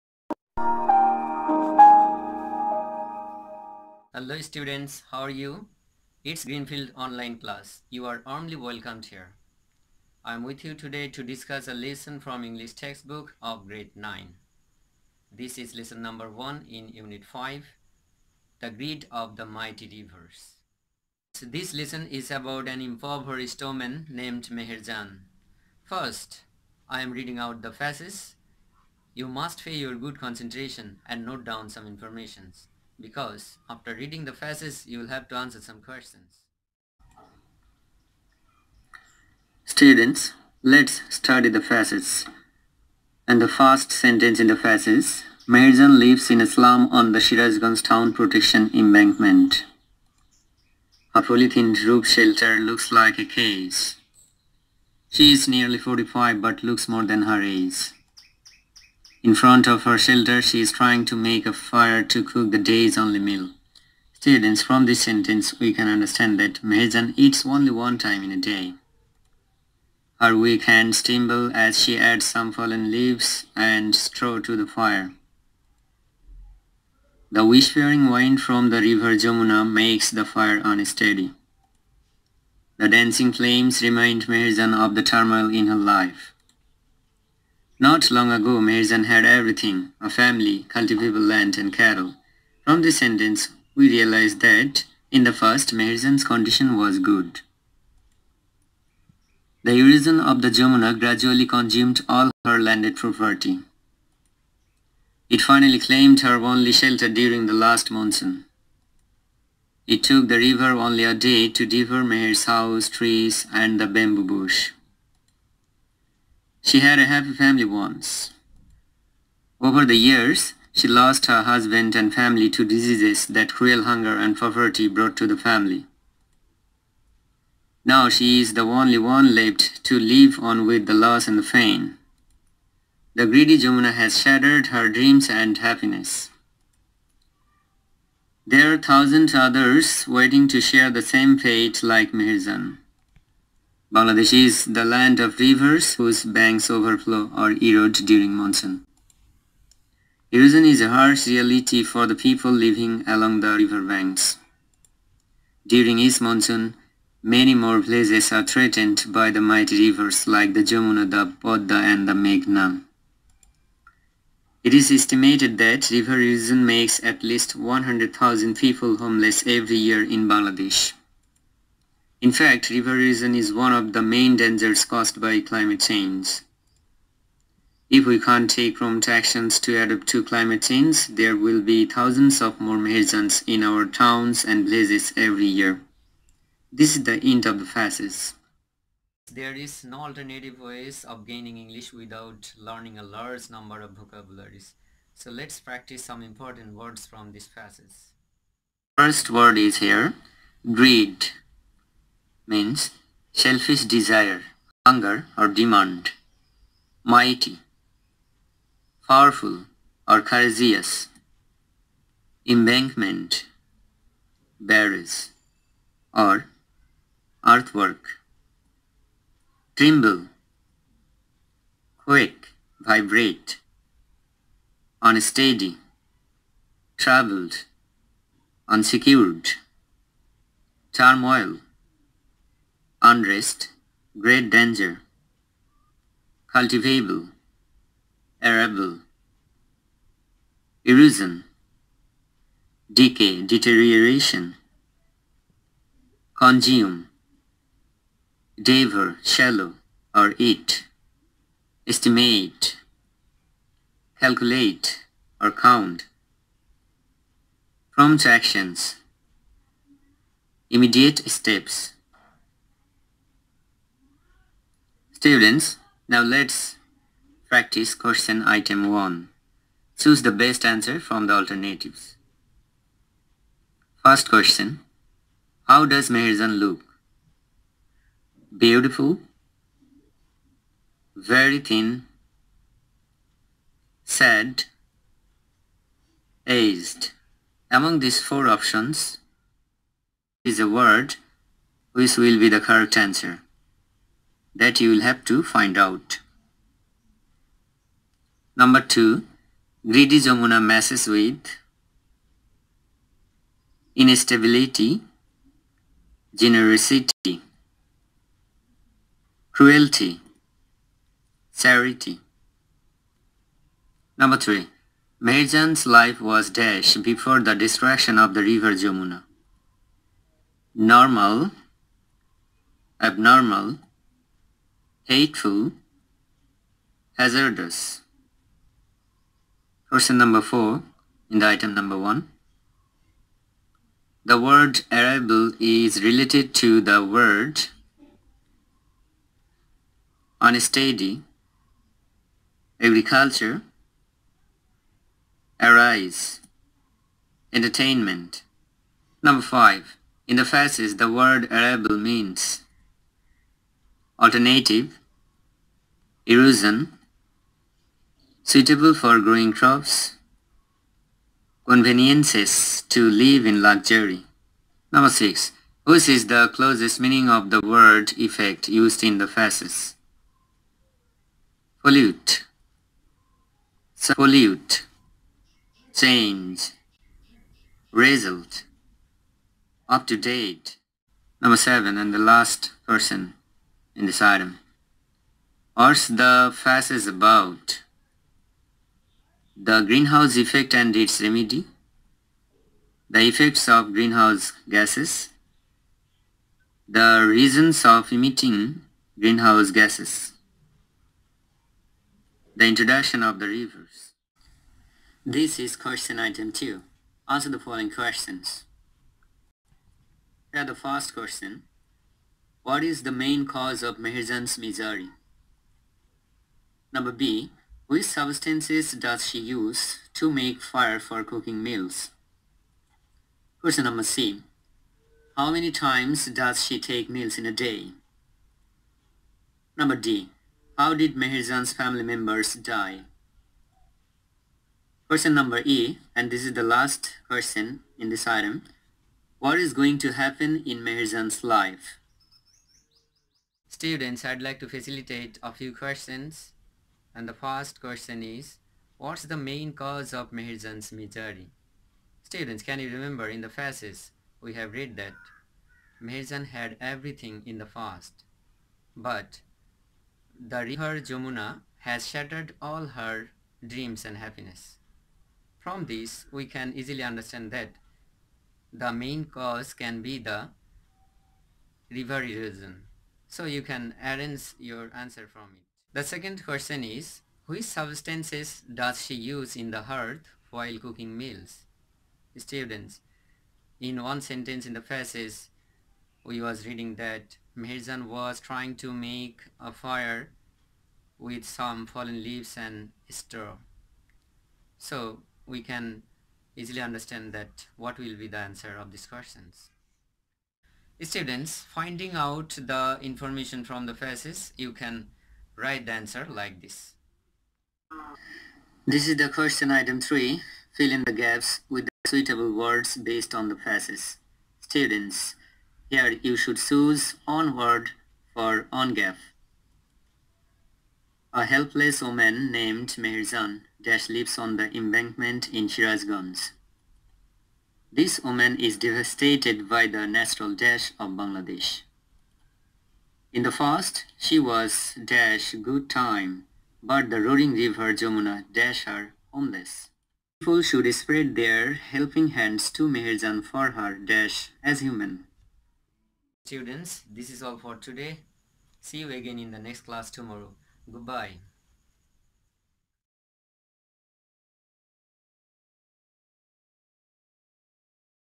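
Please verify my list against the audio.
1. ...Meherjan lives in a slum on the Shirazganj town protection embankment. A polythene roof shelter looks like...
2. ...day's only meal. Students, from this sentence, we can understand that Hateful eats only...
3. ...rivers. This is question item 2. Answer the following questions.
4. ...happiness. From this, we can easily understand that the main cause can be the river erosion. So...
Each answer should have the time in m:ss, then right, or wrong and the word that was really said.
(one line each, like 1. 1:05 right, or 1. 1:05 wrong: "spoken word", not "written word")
1. 0:45 right
2. 1:02 wrong: "Meherjan", not "Hateful"
3. 6:43 right
4. 7:44 right.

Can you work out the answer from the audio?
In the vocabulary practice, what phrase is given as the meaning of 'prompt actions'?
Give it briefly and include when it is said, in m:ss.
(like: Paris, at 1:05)
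Immediate steps, at 4:20.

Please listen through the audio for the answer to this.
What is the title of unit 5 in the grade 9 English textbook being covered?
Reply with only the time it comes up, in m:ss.
0:18.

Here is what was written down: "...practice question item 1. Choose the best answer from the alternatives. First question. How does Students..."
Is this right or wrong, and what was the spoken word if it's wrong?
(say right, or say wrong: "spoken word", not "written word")
wrong: "Meherjan", not "Students".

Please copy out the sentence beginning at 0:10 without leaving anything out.
I am with you today to discuss a lesson from English textbook of grade 9.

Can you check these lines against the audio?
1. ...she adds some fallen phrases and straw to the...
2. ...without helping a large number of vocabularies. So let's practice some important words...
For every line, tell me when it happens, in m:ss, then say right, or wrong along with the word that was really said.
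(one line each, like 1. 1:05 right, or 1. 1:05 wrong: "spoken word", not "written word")
1. 1:11 wrong: "leaves", not "phrases"
2. 3:11 wrong: "learning", not "helping".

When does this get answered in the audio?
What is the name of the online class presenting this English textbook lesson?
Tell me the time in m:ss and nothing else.
0:06.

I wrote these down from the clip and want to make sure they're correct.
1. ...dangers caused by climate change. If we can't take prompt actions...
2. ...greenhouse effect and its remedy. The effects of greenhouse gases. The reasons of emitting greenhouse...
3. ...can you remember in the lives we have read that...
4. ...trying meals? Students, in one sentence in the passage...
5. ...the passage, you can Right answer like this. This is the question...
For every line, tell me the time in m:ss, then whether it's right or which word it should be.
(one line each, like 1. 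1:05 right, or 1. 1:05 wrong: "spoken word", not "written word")
1. 2:54 right
2. 6:29 right
3. 7:32 wrong: "phases", not "lives"
4. 8:00 wrong: "cooking", not "trying"
5. 8:23 right.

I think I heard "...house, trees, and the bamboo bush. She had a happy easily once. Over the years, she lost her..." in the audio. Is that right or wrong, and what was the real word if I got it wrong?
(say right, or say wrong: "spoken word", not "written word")
wrong: "family", not "easily".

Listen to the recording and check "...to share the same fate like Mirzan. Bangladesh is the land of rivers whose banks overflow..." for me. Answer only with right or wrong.
right.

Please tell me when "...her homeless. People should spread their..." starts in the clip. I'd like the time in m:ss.
8:58.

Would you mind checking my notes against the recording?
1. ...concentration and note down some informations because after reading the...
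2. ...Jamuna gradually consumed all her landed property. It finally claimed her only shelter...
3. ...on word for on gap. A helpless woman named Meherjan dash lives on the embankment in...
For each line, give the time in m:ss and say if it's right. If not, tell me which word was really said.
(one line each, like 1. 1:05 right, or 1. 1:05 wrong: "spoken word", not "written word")
1. 0:30 right
2. 1:40 right
3. 8:37 right.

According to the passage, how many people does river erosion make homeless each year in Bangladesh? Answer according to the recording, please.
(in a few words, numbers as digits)
100,000.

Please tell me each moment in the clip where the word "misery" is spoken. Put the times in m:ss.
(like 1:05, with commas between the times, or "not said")
6:54, 7:30.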